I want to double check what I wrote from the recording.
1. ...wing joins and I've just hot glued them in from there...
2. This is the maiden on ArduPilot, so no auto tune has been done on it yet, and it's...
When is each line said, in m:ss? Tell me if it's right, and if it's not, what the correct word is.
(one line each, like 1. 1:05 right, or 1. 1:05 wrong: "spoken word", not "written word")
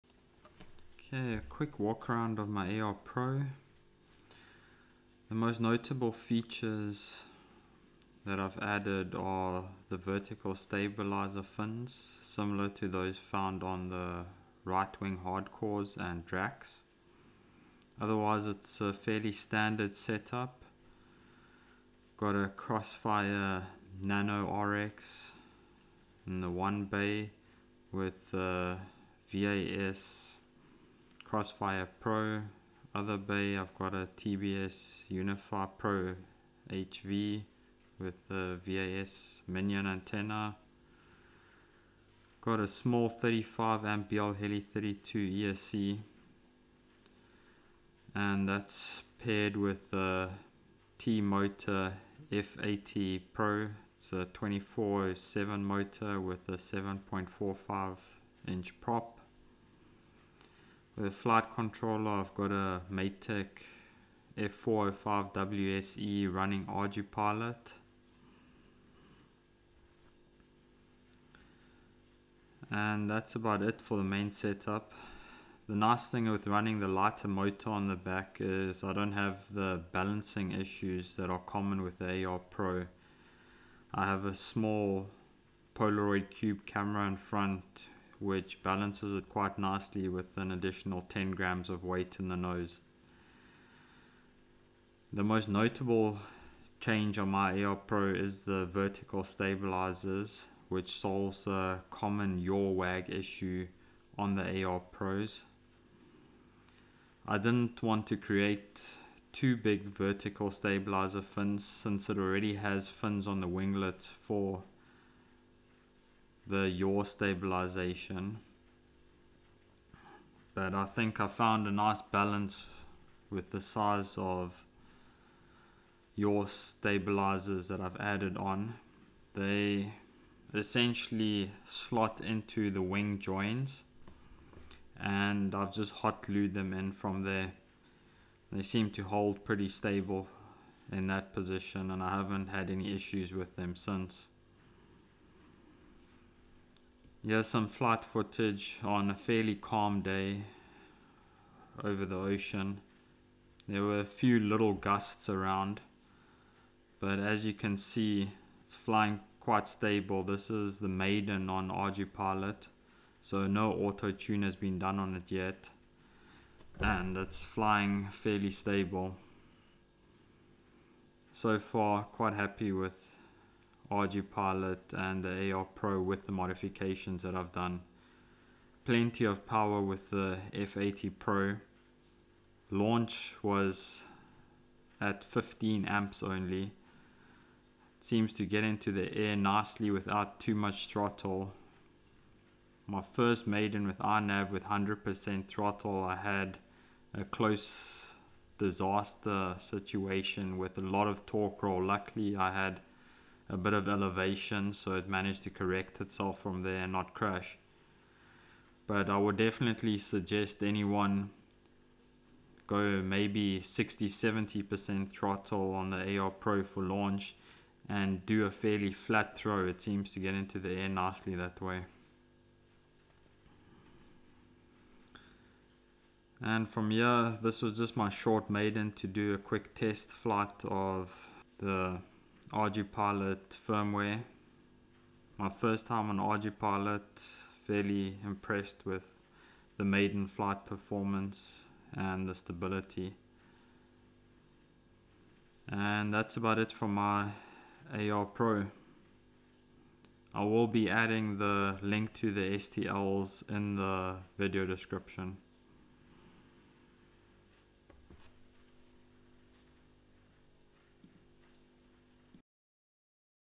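1. 2:12 right
2. 2:40 right.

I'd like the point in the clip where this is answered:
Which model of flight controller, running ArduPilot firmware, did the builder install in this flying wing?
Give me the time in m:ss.
1:02.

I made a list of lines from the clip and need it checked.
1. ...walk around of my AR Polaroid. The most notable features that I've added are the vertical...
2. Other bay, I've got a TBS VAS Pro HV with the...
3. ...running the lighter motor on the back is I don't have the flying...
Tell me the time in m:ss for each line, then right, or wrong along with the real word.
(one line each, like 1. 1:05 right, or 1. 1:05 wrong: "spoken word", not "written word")
1. 0:01 wrong: "Pro", not "Polaroid"
2. 0:32 wrong: "Unify", not "VAS"
3. 1:16 wrong: "balancing", not "flying".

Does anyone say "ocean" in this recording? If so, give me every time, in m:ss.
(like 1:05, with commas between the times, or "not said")
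2:32.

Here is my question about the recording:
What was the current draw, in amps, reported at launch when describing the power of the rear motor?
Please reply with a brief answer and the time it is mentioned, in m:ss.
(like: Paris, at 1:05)
15 amps, at 3:05.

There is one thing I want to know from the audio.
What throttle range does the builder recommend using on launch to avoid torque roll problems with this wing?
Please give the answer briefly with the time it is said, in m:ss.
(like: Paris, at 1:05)
60-70%, at 3:33.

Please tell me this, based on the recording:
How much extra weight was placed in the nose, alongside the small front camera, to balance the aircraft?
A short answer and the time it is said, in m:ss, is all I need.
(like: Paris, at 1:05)
10 grams, at 1:31.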